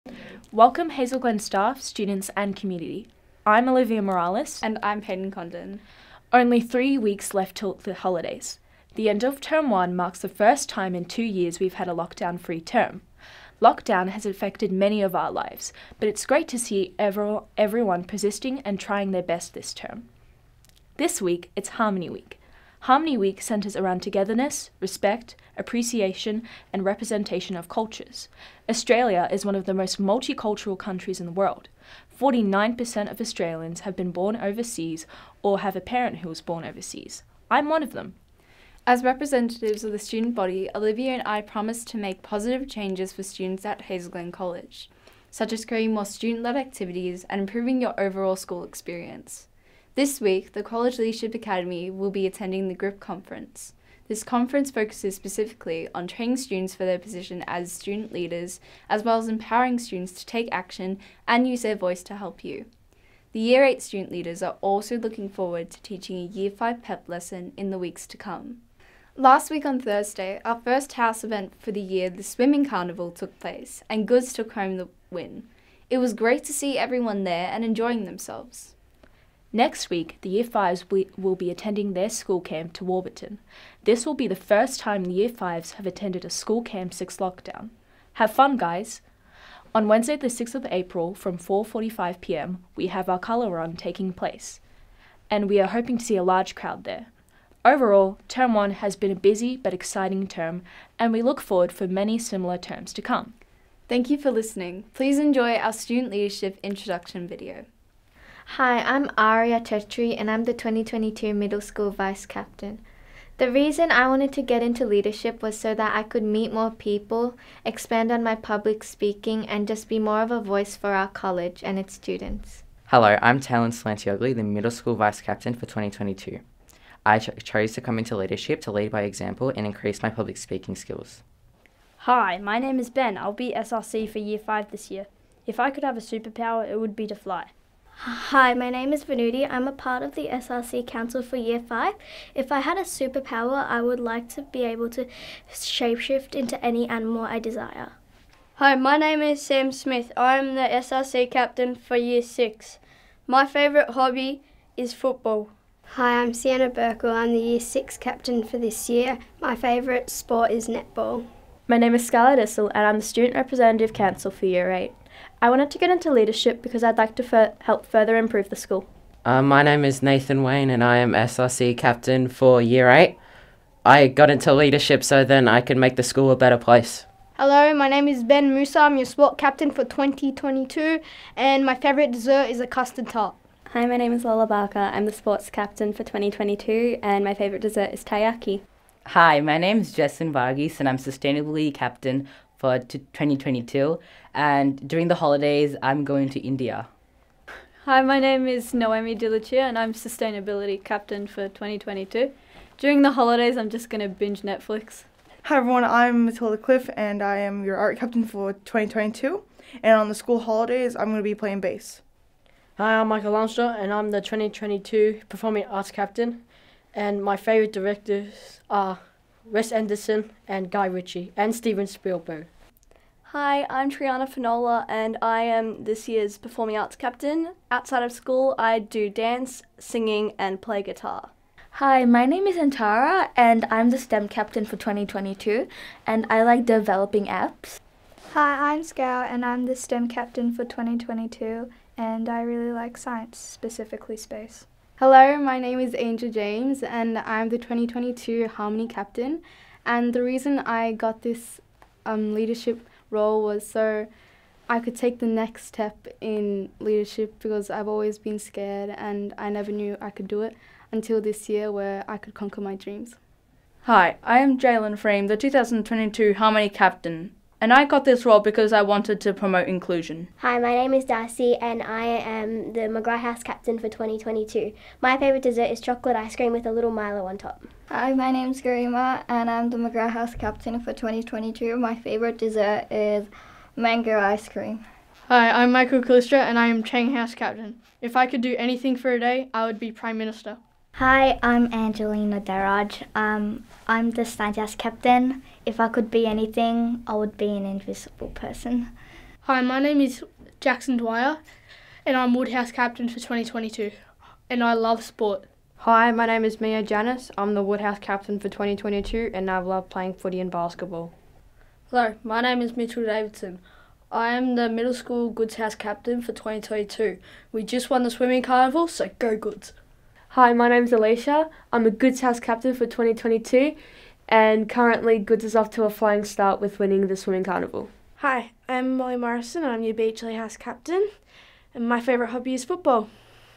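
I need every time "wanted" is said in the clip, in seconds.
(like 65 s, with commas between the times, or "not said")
114 s, 165 s, 268 s.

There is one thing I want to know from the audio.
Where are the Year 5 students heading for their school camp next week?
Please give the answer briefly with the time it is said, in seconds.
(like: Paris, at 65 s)
Warburton, at 82 s.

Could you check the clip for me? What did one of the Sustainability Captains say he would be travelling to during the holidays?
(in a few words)
India.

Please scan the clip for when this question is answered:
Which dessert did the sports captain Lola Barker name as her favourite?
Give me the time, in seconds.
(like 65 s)
188 s.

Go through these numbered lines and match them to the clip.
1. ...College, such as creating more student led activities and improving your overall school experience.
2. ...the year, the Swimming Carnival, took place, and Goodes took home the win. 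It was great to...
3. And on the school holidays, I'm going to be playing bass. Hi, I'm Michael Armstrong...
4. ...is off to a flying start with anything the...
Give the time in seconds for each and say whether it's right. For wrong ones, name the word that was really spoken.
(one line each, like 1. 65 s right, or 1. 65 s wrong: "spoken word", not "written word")
1. 44 s right
2. 71 s right
3. 209 s right
4. 325 s wrong: "winning", not "anything".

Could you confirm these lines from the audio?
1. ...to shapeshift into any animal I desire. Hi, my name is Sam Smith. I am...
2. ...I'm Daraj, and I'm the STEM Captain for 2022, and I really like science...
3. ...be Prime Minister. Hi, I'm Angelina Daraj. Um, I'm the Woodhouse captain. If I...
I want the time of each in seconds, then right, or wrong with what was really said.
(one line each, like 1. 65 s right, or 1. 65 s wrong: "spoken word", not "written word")
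1. 144 s right
2. 238 s wrong: "Scout", not "Daraj"
3. 289 s wrong: "Stardust", not "Woodhouse".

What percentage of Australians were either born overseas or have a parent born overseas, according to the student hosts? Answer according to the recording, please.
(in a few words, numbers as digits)
49%.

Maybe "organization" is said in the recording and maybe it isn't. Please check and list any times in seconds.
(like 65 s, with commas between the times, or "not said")
not said.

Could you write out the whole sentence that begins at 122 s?
Hello, I'm Talon Slantiogli, the middle school vice captain for 2022.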